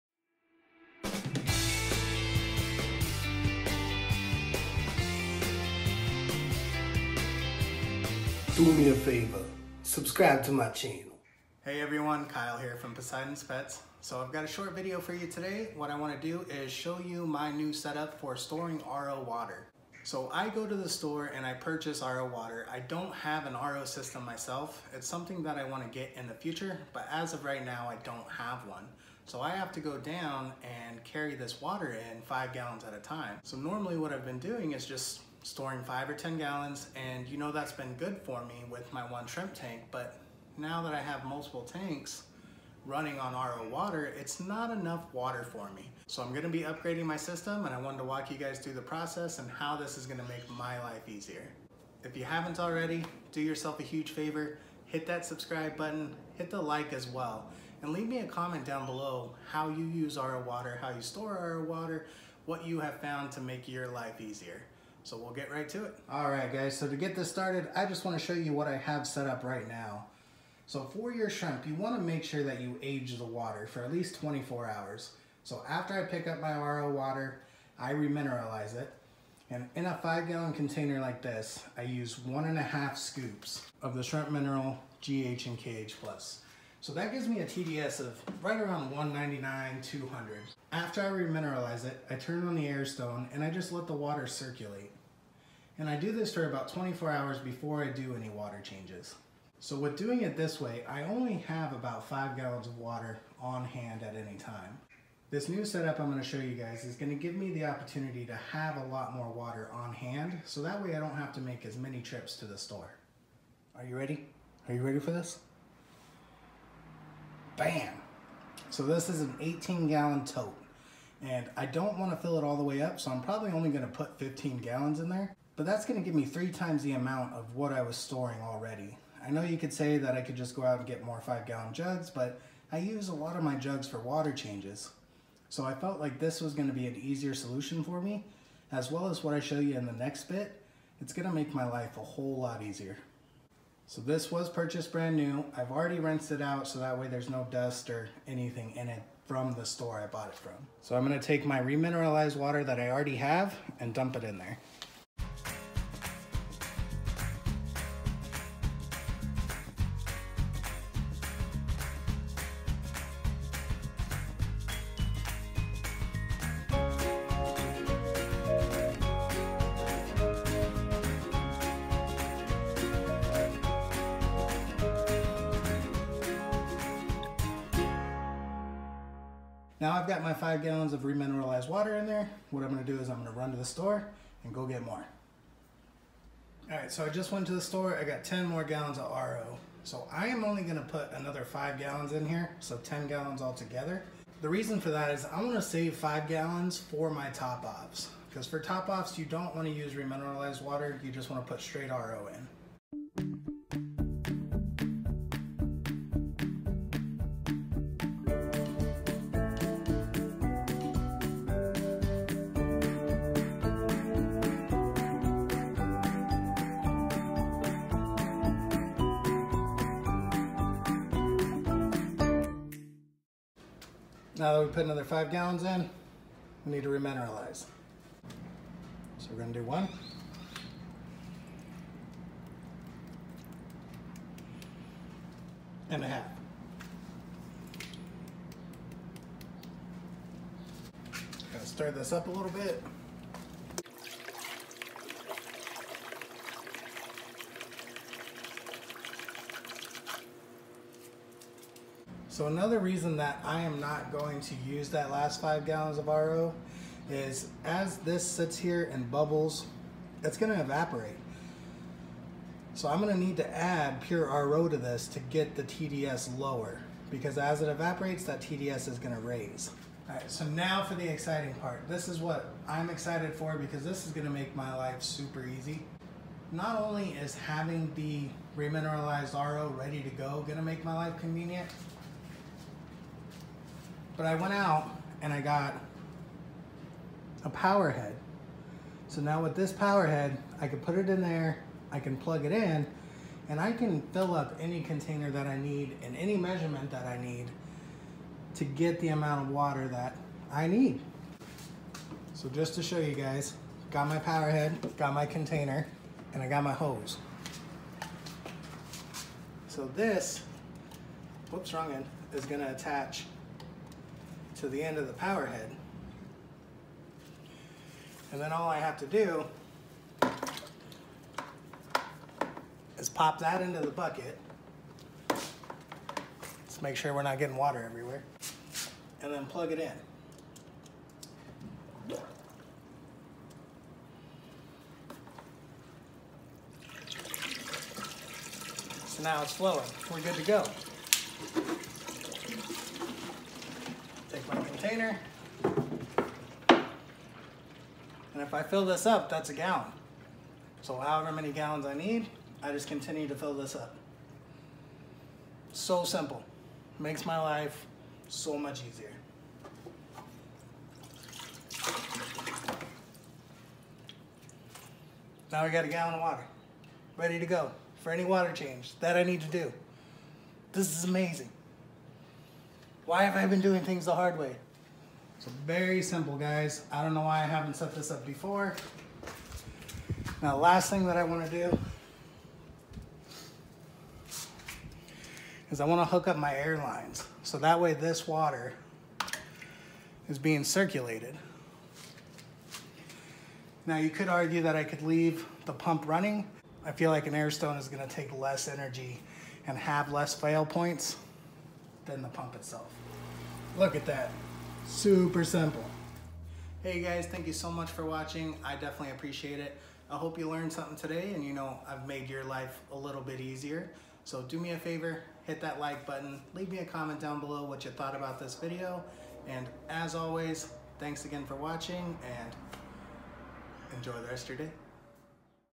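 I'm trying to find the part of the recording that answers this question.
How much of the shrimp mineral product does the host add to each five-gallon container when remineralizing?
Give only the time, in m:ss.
1:22.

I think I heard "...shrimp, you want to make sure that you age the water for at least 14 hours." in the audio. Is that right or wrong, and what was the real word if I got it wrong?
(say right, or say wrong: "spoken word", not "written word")
wrong: "24", not "14".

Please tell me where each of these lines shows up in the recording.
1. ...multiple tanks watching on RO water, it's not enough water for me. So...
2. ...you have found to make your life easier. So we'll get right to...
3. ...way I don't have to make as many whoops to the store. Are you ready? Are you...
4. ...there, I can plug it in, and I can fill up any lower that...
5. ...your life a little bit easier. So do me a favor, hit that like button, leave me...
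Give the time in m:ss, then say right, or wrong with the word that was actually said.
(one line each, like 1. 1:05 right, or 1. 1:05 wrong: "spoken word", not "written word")
1. 0:41 wrong: "running", not "watching"
2. 1:02 right
3. 1:50 wrong: "trips", not "whoops"
4. 4:51 wrong: "container", not "lower"
5. 6:52 right.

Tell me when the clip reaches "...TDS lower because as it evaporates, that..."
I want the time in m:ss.
4:25.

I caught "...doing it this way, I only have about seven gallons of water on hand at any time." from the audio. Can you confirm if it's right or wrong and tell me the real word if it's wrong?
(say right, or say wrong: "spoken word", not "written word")
wrong: "five", not "seven".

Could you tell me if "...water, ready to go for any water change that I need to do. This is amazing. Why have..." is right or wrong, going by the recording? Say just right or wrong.
right.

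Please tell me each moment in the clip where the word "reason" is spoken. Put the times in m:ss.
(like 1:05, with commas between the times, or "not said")
3:14, 4:12.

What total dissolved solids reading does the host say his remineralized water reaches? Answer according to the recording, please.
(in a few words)
around 200.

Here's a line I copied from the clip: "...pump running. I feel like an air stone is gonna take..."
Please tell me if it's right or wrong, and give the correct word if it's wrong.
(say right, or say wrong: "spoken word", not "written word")
right.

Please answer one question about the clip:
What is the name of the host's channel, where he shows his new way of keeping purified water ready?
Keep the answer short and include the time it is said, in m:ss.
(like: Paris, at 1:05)
Poseidon's Pets, at 0:12.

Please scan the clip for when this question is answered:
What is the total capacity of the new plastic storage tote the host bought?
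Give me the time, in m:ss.
1:59.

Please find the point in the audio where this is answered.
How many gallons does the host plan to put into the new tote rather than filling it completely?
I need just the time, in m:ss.
2:04.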